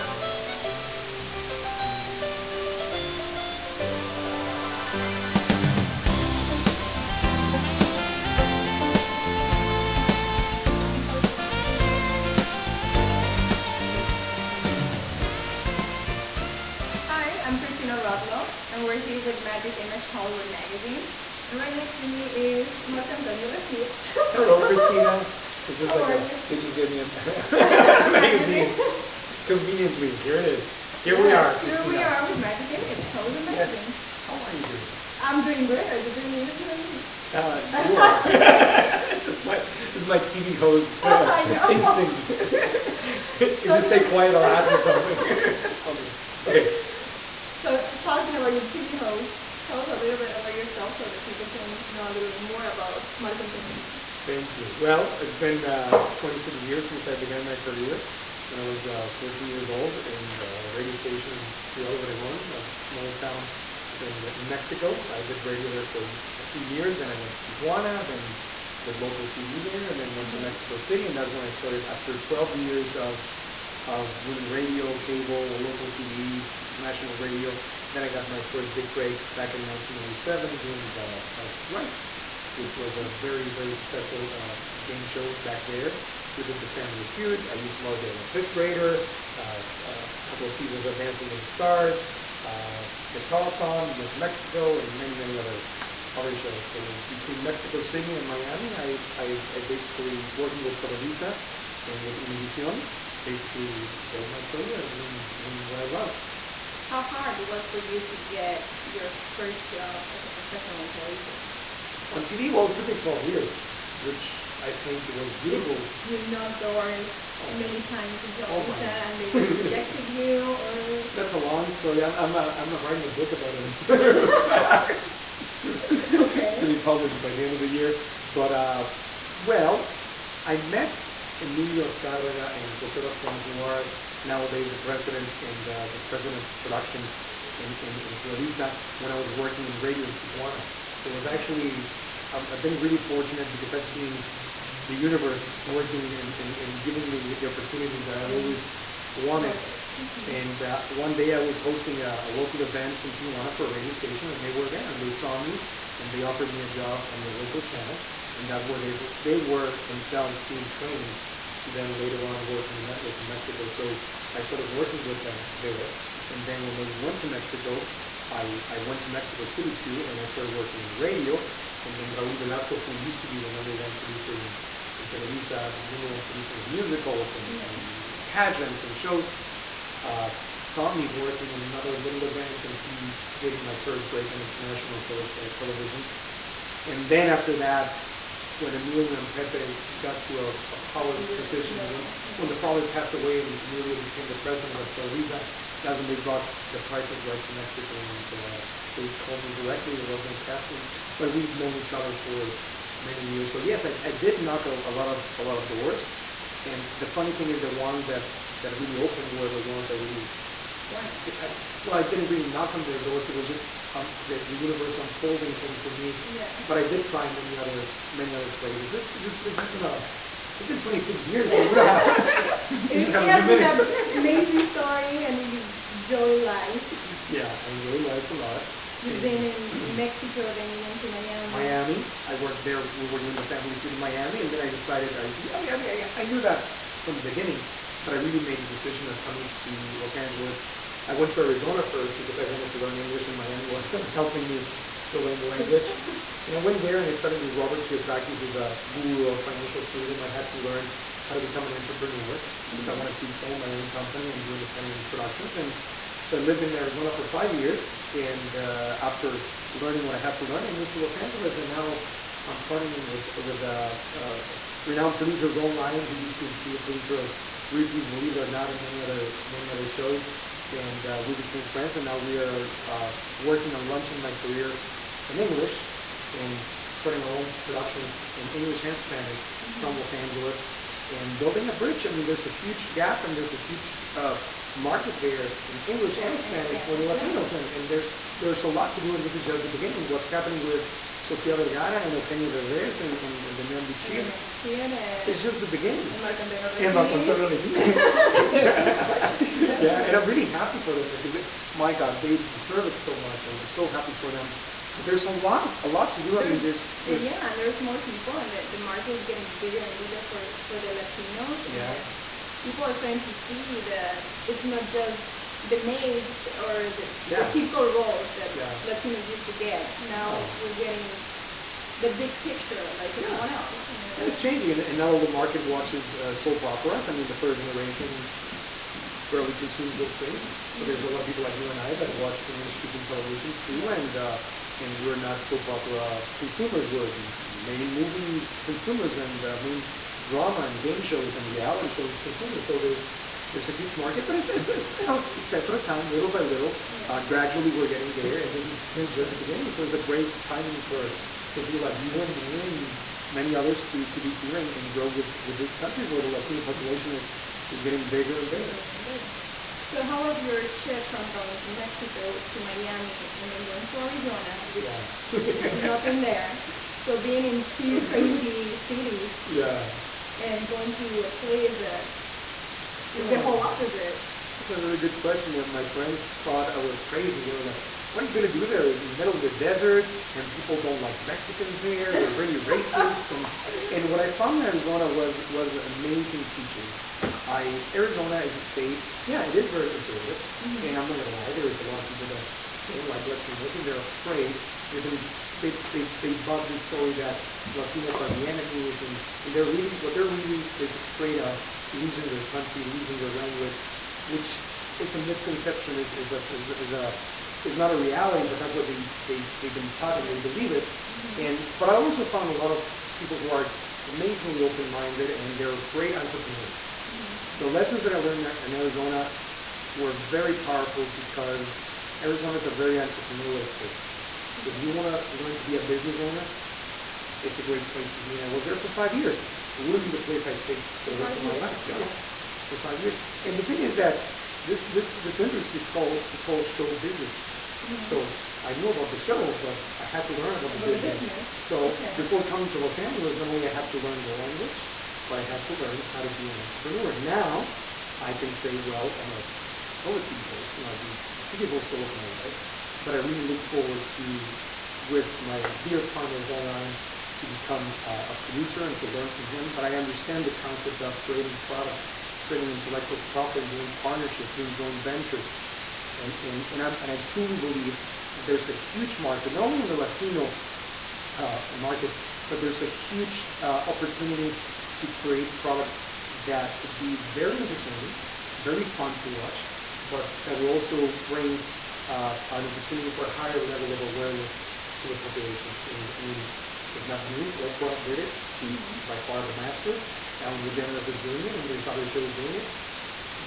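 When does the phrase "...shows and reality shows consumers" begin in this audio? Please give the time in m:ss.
5:41.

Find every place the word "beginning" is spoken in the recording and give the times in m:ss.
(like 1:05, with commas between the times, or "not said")
3:57, 4:49, 4:55, 5:49.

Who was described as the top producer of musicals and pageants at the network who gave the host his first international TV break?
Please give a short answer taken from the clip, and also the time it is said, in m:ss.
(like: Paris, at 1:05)
Raul Velasco, at 2:52.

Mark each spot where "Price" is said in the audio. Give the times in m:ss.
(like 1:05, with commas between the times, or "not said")
1:21, 3:16.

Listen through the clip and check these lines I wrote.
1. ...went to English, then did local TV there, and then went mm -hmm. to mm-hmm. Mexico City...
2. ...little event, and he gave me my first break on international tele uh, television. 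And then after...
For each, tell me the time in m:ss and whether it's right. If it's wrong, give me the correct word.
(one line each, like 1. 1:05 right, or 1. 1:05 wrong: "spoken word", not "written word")
1. 1:07 wrong: "Tijuana", not "English"
2. 3:01 right.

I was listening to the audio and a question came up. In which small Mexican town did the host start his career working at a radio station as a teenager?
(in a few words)
Ciudad Obregón.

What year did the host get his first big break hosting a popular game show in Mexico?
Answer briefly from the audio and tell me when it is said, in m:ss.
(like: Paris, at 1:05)
1997, at 1:19.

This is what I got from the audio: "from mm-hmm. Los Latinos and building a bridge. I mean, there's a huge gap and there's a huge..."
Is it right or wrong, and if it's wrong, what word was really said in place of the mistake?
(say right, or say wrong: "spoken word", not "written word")
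wrong: "Angeles", not "Latinos".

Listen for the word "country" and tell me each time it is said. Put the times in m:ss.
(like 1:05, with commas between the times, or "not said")
5:55, 6:42.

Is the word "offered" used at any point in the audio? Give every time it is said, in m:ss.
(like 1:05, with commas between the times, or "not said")
2:36.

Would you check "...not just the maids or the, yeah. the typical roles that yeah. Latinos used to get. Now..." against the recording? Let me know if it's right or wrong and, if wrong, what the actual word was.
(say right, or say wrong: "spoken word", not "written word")
right.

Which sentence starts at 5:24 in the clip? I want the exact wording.
And it's changing, and, and, all the market watches uh, soap operas.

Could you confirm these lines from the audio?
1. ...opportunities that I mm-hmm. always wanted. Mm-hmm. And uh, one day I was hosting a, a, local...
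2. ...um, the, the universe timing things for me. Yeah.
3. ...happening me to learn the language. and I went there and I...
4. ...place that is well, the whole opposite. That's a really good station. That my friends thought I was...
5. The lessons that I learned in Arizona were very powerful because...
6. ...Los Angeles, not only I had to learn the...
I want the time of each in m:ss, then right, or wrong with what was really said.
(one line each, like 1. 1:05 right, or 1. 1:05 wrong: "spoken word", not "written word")
1. 2:27 right
2. 3:33 wrong: "unfolding", not "timing"
3. 4:04 wrong: "helping", not "happening"
4. 6:11 wrong: "question", not "station"
5. 6:57 right
6. 7:22 right.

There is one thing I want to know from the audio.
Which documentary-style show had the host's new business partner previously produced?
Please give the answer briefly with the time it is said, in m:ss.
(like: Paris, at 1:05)
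Ripley's Believe It or Not, at 4:27.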